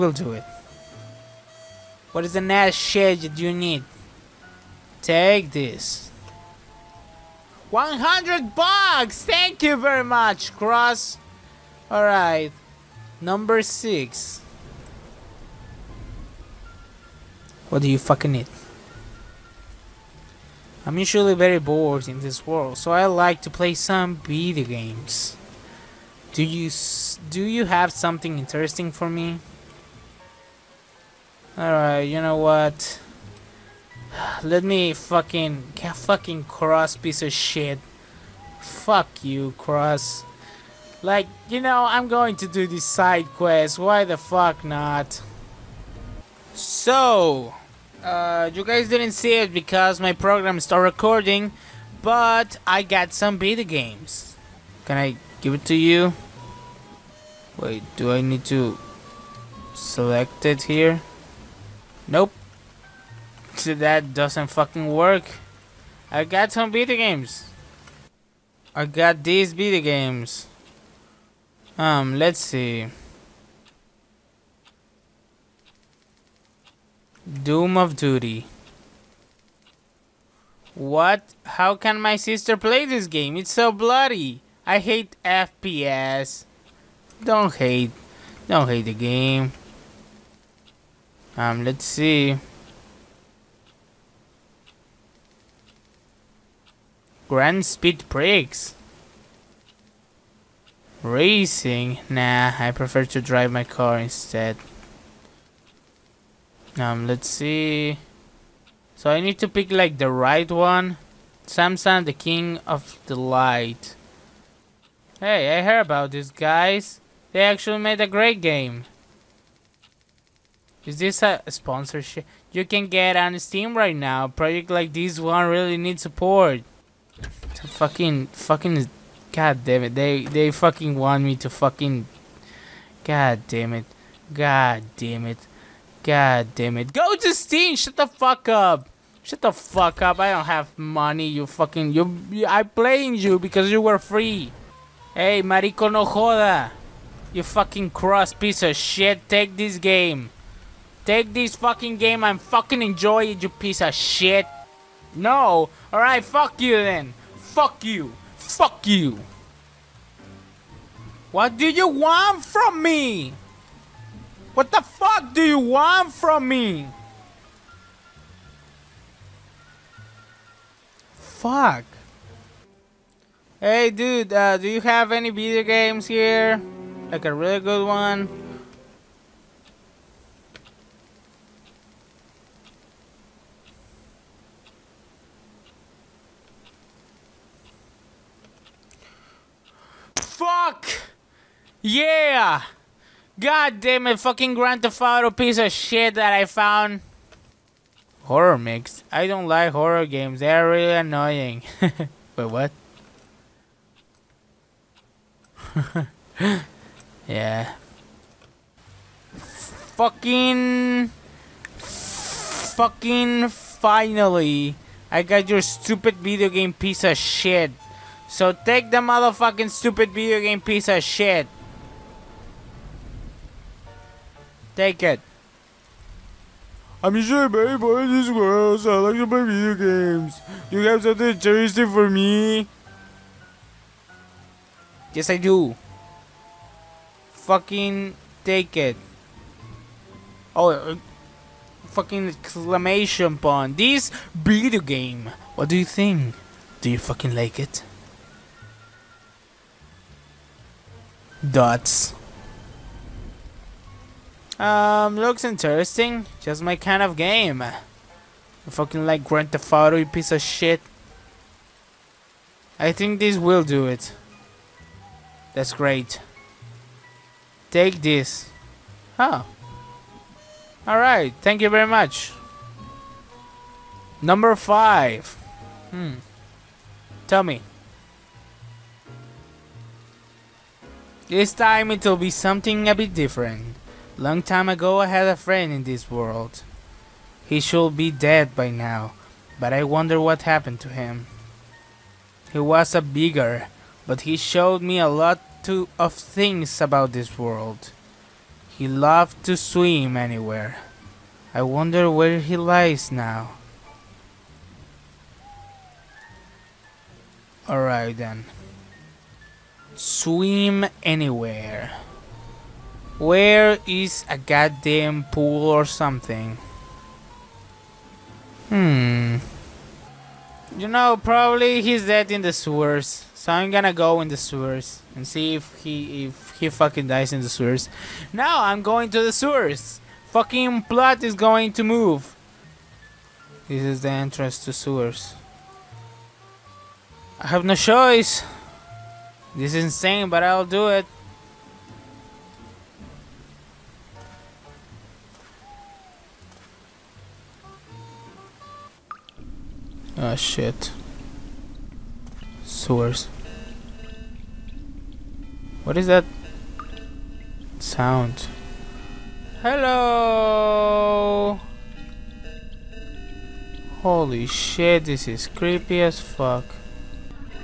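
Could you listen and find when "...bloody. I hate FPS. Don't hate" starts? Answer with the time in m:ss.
1:23.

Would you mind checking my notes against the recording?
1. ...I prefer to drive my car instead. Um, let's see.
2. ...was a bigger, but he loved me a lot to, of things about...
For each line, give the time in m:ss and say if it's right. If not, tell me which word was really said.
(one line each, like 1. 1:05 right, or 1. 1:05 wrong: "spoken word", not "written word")
1. 1:42 right
2. 4:52 wrong: "showed", not "loved".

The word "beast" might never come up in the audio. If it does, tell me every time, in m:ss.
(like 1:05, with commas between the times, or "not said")
not said.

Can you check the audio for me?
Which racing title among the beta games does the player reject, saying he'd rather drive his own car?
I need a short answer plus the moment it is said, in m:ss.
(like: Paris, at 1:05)
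Grand Speed Breaks, at 1:37.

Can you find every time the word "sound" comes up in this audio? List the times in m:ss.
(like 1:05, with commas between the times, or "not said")
5:57.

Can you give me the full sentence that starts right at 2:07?
To fucking, fucking, god damn it.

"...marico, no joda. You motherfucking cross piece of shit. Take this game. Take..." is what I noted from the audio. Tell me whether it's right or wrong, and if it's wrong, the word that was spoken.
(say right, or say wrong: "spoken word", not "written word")
wrong: "fucking", not "motherfucking".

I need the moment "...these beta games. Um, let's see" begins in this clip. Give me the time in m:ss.
1:09.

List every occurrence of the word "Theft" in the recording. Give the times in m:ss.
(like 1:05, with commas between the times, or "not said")
3:14, 4:19.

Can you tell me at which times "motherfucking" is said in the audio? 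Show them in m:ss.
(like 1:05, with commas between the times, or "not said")
3:38.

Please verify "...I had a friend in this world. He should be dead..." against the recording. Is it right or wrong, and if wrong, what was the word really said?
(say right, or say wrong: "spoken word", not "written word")
right.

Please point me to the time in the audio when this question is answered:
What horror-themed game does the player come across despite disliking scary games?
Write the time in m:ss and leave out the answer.
3:18.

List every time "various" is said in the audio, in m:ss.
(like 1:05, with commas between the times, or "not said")
not said.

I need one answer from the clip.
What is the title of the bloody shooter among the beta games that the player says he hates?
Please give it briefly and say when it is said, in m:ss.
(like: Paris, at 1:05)
Doom of Duty, at 1:17.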